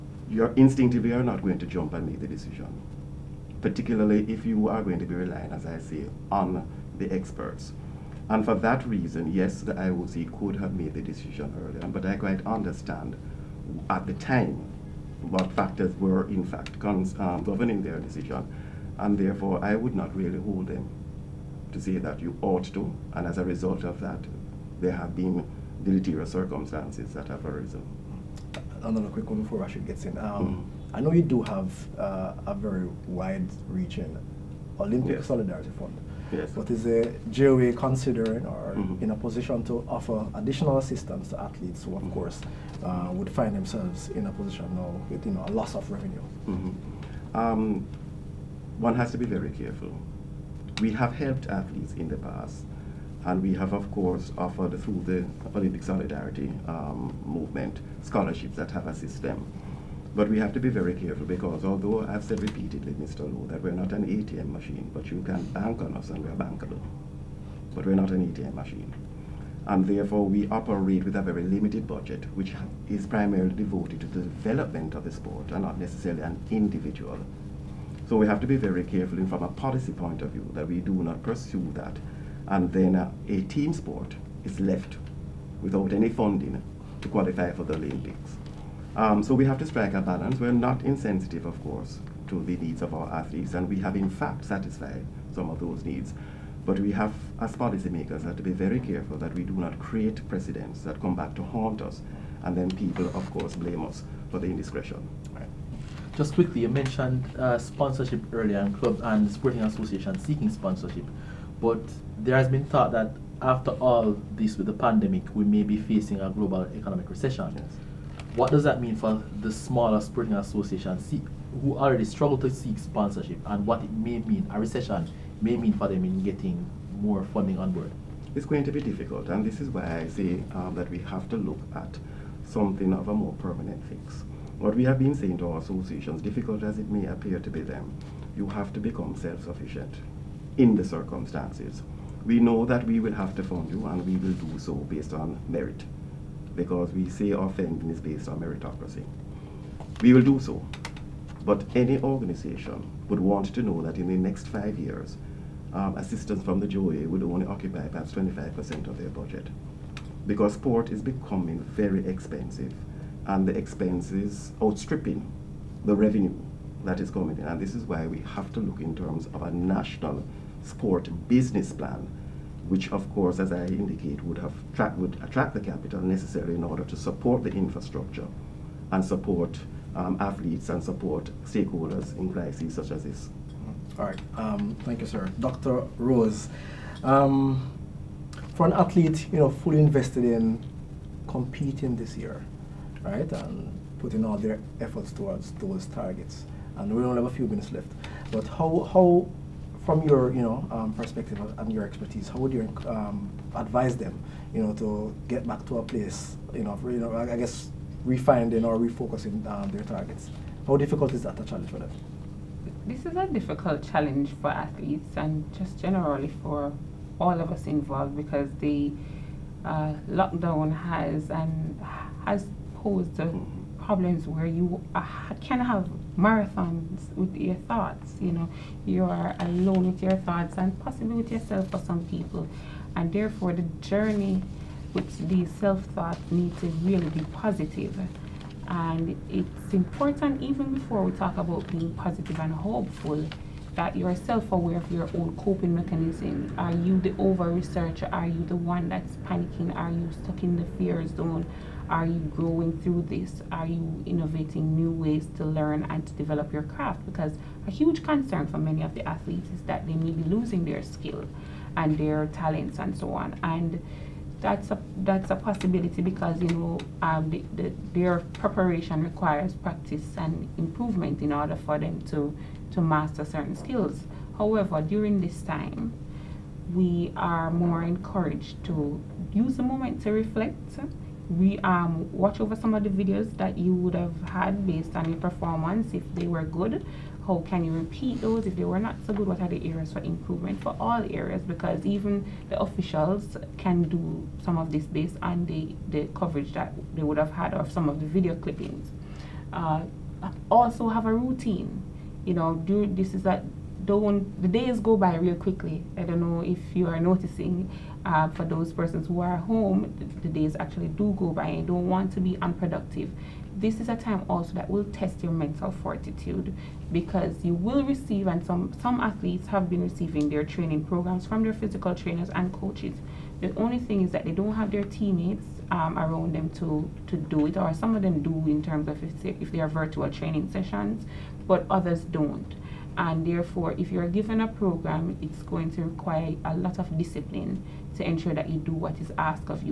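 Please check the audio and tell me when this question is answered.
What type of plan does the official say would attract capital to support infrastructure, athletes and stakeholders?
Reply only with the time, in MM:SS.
02:49.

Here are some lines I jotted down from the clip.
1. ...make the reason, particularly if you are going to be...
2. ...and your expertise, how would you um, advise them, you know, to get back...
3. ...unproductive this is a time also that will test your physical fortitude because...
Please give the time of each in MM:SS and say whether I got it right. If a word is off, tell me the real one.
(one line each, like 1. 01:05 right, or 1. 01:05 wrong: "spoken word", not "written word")
1. 00:02 wrong: "decision", not "reason"
2. 03:21 right
3. 05:12 wrong: "mental", not "physical".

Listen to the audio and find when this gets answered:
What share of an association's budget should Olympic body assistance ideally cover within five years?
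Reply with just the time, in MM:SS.
02:38.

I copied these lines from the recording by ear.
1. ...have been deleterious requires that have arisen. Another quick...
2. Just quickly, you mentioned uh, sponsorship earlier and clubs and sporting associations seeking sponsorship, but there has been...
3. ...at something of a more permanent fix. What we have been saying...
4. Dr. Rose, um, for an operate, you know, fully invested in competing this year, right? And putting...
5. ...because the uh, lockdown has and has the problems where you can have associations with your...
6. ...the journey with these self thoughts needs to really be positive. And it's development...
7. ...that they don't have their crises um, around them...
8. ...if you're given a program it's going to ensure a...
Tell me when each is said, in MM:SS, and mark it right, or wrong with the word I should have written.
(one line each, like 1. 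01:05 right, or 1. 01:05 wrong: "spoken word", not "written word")
1. 00:24 wrong: "circumstances", not "requires"
2. 01:46 right
3. 02:11 right
4. 03:05 wrong: "athlete", not "operate"
5. 03:38 wrong: "marathons", not "associations"
6. 03:53 wrong: "important", not "development"
7. 05:24 wrong: "teammates", not "crises"
8. 05:33 wrong: "require", not "ensure".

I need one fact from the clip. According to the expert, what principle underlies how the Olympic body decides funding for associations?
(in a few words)
meritocracy.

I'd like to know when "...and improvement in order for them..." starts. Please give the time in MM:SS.
04:30.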